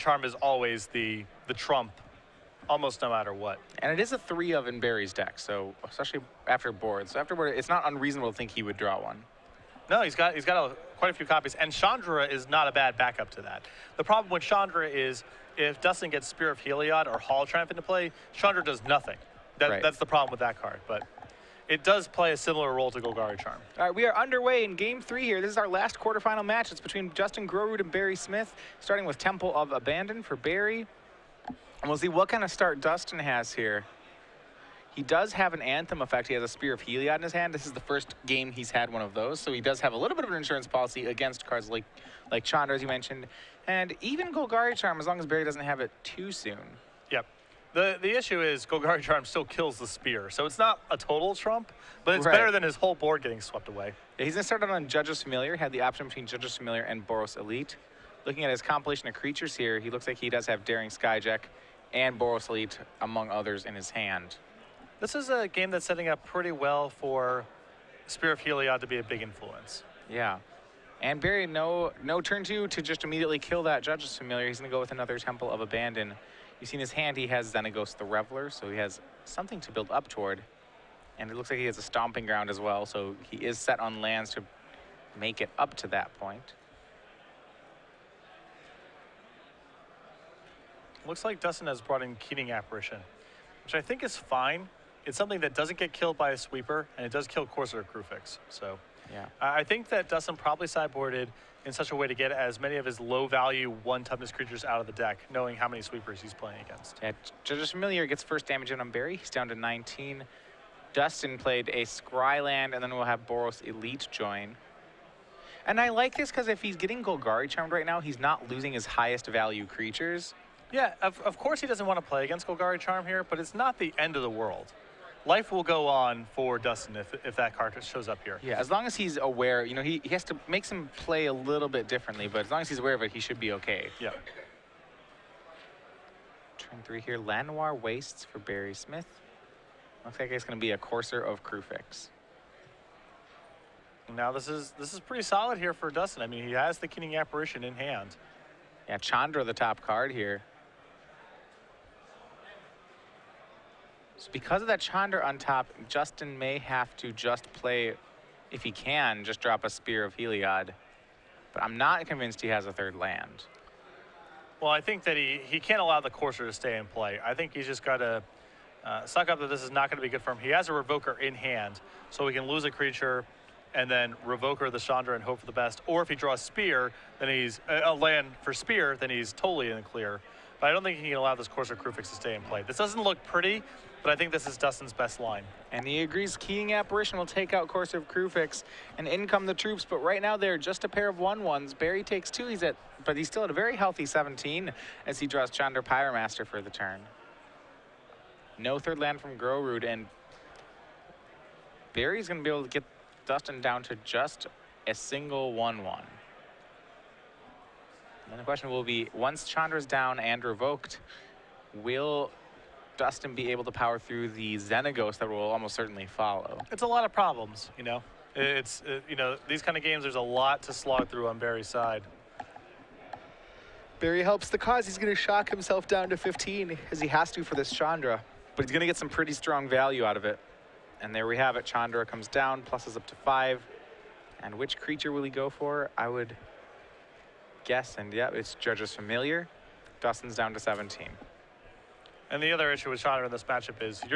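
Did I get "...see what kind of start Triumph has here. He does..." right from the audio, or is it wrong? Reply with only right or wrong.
wrong.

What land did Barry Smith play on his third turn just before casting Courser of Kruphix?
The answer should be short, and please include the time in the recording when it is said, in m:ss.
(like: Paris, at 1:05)
Llanowar Wastes, at 2:17.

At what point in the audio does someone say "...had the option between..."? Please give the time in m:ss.
0:55.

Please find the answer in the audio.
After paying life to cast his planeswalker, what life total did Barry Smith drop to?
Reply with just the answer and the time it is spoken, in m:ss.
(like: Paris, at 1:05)
15, at 3:45.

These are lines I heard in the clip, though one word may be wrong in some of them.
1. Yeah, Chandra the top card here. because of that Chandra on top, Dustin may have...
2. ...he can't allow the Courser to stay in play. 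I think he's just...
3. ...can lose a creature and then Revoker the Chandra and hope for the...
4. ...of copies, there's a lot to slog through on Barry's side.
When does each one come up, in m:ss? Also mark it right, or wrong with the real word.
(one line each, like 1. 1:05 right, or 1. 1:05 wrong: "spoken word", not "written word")
1. 2:28 right
2. 2:45 right
3. 2:52 right
4. 3:39 wrong: "games", not "copies".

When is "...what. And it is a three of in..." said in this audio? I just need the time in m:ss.
0:03.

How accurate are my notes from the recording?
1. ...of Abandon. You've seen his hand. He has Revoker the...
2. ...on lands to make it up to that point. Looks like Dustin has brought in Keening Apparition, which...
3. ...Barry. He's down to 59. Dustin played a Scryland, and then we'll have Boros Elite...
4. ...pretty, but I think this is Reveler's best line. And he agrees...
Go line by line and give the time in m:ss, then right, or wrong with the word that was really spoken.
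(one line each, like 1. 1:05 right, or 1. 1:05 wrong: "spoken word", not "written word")
1. 1:15 wrong: "Xenagos", not "Revoker"
2. 1:23 right
3. 1:48 wrong: "19", not "59"
4. 3:03 wrong: "Dustin", not "Reveler".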